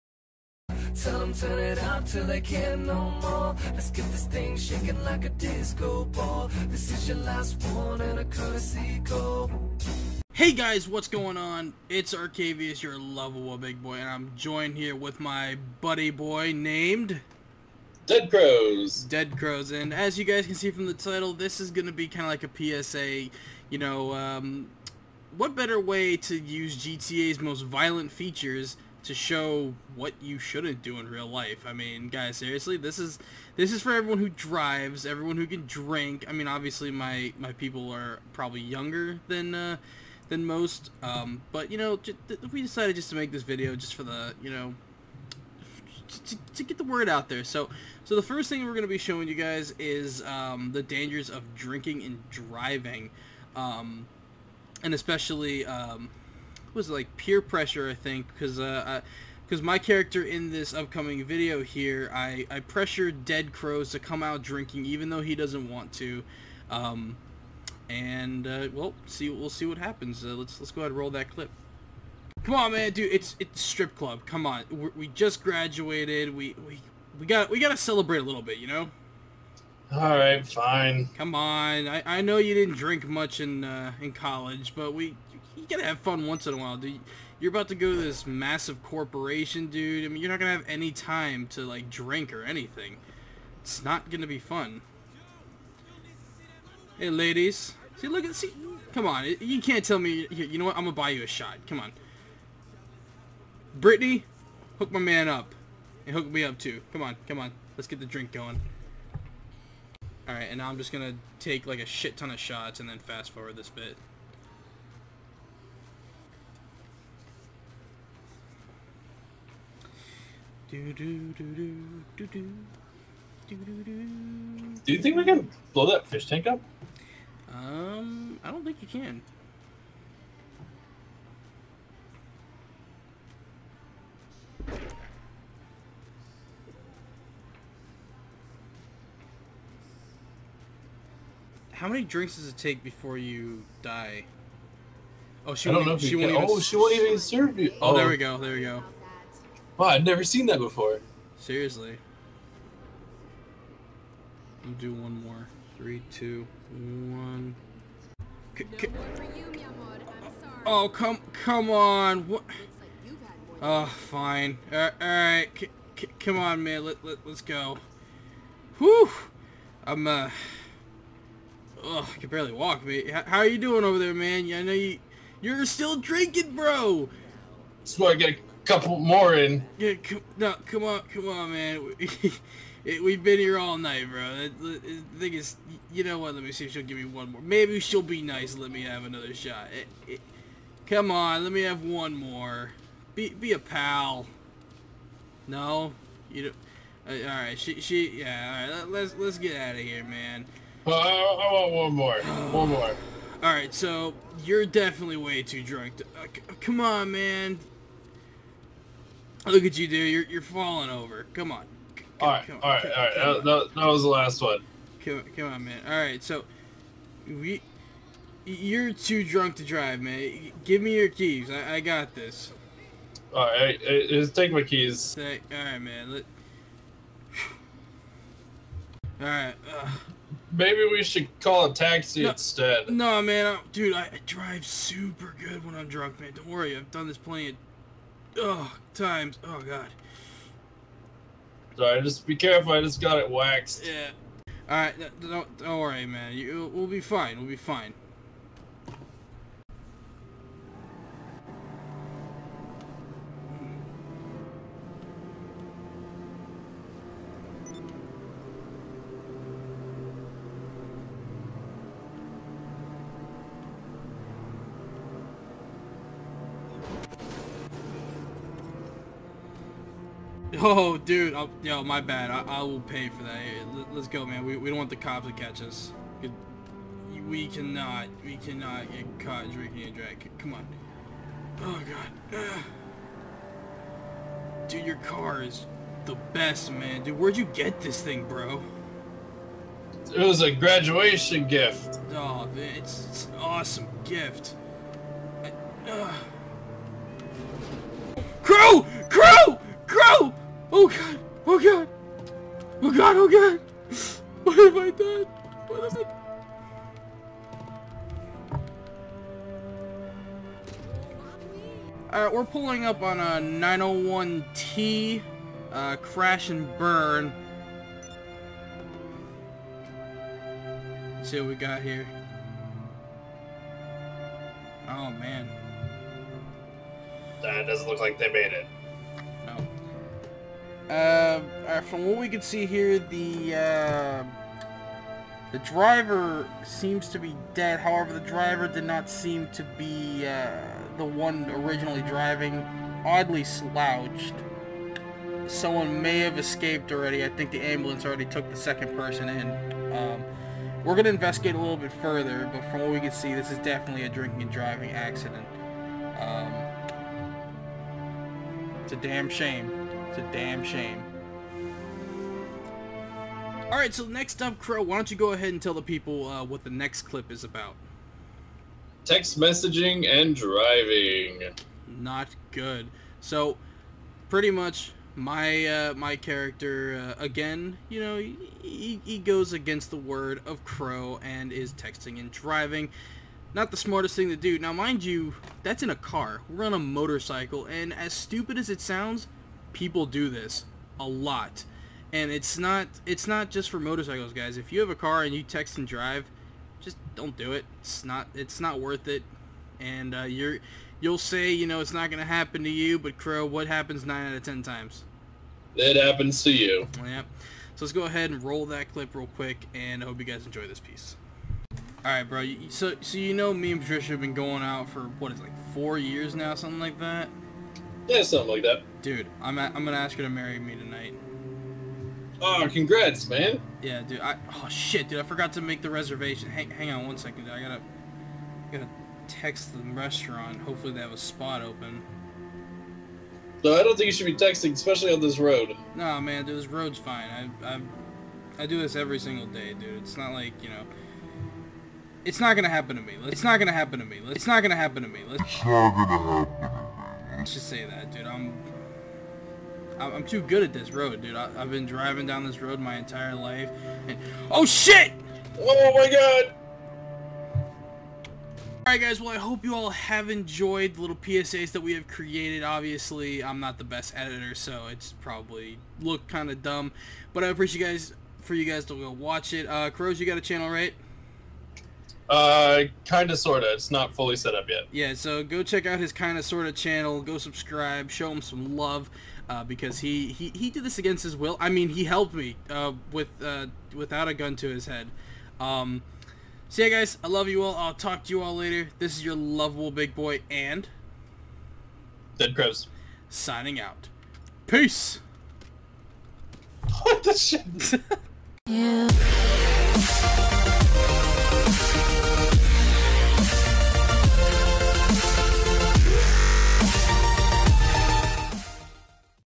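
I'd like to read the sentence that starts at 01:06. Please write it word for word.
Um, and uh, well, see we'll see what happens.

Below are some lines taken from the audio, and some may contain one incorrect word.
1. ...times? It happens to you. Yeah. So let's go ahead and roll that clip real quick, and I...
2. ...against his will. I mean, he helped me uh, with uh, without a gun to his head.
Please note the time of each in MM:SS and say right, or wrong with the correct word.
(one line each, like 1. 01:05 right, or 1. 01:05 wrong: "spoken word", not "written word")
1. 06:44 right
2. 08:00 right.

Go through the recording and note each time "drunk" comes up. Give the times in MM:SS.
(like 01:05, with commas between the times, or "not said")
03:25, 03:39, 03:55.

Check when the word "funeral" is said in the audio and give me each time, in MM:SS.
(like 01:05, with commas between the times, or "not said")
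not said.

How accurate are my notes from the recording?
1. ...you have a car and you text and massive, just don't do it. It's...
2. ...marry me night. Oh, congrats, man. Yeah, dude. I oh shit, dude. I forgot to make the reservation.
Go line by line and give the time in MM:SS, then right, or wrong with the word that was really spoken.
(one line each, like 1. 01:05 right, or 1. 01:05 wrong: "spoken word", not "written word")
1. 06:34 wrong: "drive", not "massive"
2. 07:00 wrong: "tonight", not "night".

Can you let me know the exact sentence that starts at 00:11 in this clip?
It's Arcaviouse, your lovable big boy, and I'm joined here with my buddy boy named...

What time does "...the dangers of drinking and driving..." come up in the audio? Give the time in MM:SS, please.
00:50.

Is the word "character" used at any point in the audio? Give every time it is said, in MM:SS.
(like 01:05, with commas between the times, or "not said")
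00:59, 06:16.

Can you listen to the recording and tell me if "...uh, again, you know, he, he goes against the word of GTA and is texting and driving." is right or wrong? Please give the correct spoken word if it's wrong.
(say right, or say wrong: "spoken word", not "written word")
wrong: "Crow", not "GTA".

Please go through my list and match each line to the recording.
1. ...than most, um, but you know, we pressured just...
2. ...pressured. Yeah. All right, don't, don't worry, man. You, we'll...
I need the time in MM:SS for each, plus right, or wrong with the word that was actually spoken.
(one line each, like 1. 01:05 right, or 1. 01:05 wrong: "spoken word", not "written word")
1. 00:40 wrong: "decided", not "pressured"
2. 04:03 wrong: "waxed", not "pressured".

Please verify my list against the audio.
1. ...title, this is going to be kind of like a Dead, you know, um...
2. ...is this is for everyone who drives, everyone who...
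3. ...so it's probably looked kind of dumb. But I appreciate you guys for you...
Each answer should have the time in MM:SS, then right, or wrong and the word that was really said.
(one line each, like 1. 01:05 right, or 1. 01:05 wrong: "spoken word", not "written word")
1. 00:20 wrong: "PSA", not "Dead"
2. 00:32 right
3. 07:44 right.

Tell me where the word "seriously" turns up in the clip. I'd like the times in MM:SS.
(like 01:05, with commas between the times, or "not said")
00:32, 02:31.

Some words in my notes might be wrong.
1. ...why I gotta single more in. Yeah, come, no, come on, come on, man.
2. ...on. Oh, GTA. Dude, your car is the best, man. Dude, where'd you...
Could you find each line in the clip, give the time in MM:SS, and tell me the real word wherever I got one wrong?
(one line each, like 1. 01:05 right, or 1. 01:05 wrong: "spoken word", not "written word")
1. 02:57 wrong: "couple", not "single"
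2. 04:40 wrong: "God", not "GTA".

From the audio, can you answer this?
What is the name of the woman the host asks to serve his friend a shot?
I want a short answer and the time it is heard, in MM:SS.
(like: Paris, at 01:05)
Brittany, at 01:43.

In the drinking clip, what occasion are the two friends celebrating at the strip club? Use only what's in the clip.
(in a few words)
Graduation.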